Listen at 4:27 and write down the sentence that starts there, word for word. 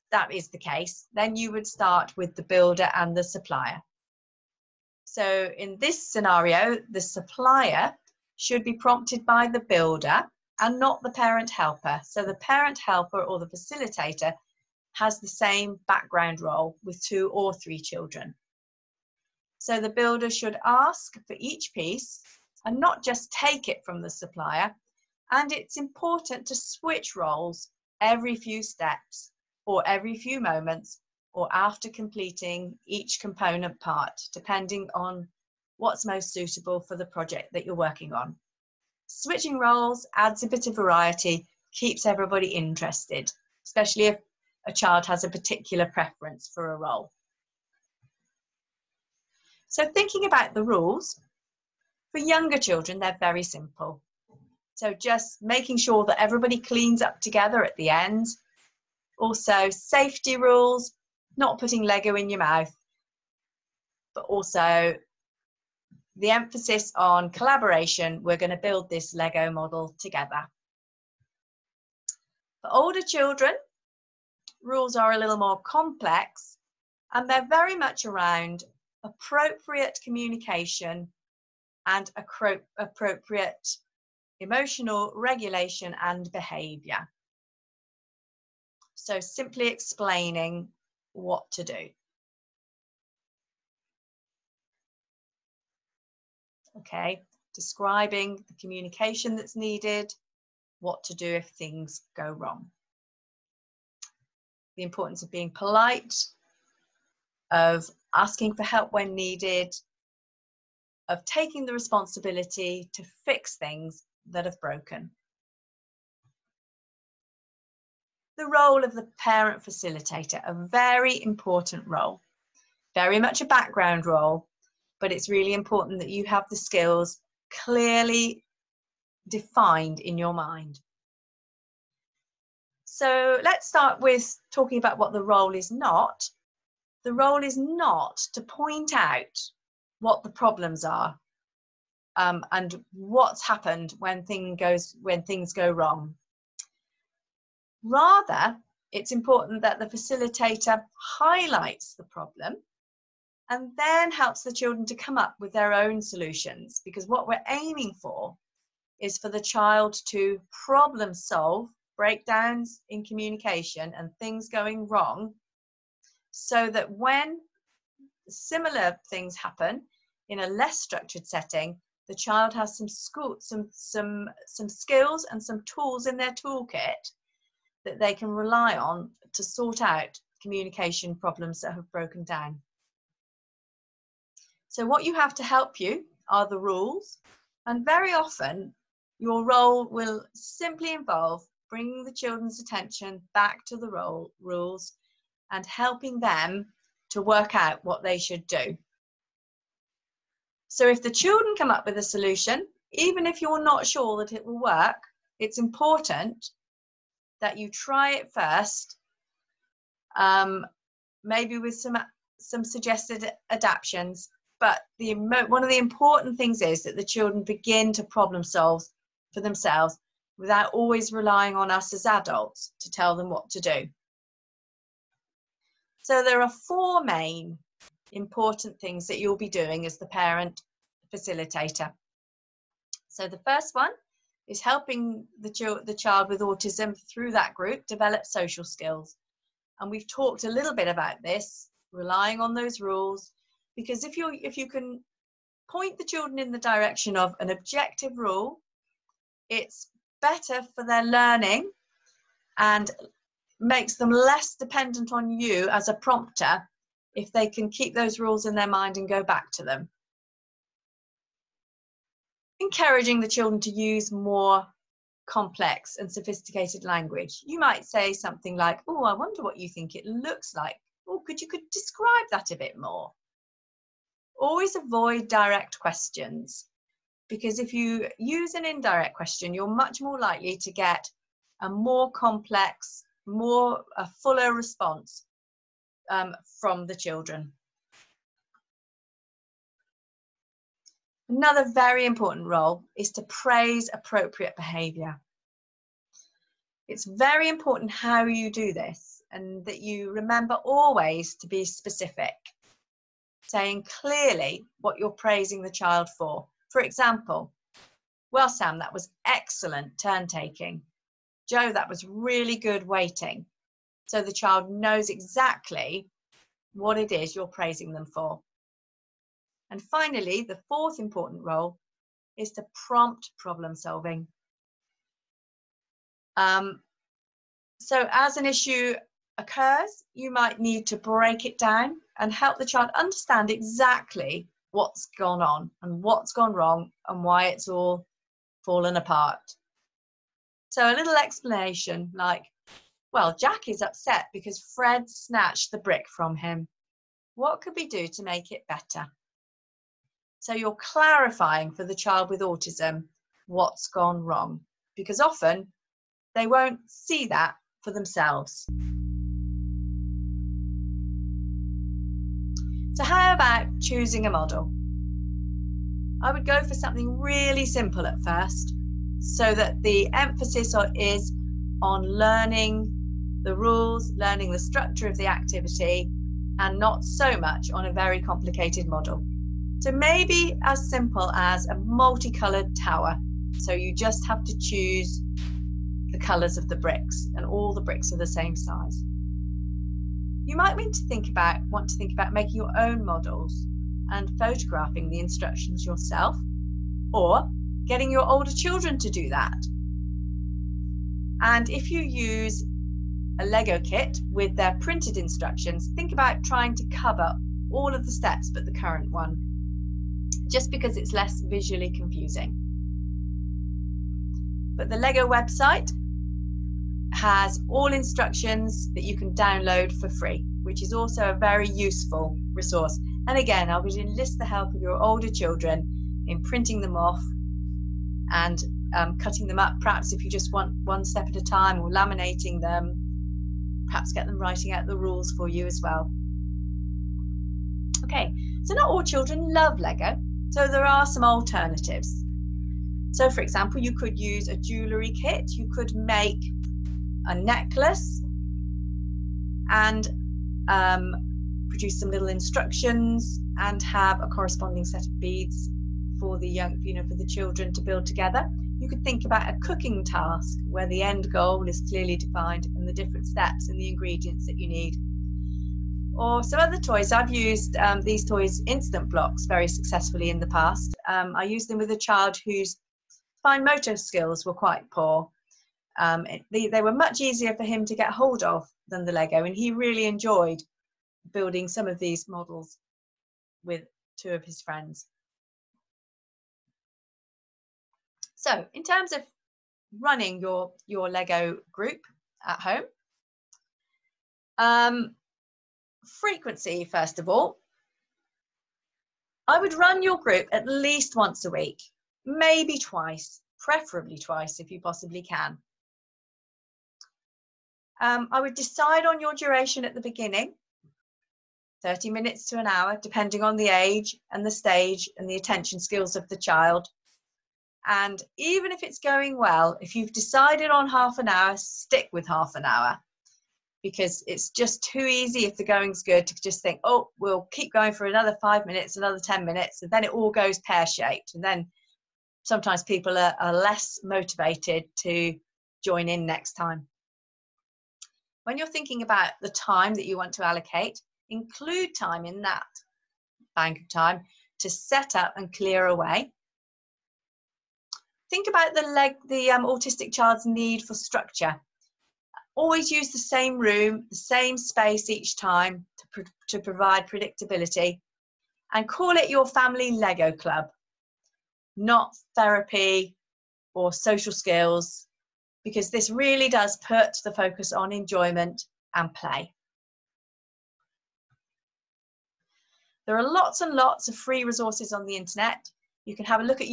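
You might say something like, Oh, I wonder what you think it looks like.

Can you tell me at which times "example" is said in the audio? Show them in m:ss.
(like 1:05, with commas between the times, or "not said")
5:06, 7:23.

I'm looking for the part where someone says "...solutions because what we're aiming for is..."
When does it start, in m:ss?
2:36.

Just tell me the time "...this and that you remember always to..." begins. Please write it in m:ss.
4:58.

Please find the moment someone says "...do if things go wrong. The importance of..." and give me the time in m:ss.
1:41.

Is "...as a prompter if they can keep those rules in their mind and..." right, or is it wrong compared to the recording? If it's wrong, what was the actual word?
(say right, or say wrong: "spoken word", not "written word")
right.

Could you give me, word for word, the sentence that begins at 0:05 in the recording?
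So in this scenario, the supplier should be prompted by the builder and not the parent helper.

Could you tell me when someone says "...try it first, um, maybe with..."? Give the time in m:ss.
3:27.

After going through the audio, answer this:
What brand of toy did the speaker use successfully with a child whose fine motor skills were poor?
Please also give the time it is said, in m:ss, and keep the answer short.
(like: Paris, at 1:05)
Instant blocks, at 7:48.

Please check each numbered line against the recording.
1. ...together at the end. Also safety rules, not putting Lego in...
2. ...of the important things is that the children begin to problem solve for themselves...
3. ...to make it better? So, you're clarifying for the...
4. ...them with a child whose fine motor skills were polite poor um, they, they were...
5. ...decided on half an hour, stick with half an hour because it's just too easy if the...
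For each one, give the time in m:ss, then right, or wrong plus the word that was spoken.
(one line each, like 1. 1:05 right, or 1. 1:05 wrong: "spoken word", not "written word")
1. 0:57 right
2. 3:35 right
3. 5:48 right
4. 7:51 wrong: "quite", not "polite"
5. 8:40 right.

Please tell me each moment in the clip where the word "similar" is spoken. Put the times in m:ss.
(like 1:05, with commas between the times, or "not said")
2:48.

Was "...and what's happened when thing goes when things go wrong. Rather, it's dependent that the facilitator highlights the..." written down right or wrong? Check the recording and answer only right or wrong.
wrong.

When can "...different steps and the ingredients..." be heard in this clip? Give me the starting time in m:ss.
7:42.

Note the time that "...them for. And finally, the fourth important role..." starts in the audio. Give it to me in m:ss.
5:17.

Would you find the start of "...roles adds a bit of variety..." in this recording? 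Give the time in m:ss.
0:39.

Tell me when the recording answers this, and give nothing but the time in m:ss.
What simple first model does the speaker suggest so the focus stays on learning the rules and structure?
6:21.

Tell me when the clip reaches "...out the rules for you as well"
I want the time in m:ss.
7:14.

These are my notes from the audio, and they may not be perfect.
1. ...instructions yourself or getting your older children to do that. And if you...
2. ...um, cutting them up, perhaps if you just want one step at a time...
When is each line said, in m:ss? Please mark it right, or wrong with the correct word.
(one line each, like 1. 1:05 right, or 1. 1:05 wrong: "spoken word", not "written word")
1. 6:35 right
2. 7:08 right.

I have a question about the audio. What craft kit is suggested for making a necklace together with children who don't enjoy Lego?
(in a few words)
A jewellery kit.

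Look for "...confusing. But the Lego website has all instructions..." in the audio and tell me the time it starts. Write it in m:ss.
6:51.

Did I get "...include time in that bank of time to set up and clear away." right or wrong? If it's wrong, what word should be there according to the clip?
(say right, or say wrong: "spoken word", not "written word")
right.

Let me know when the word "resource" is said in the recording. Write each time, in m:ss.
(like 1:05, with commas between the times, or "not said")
7:02, 9:34.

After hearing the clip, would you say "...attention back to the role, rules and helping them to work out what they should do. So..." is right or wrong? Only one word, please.
right.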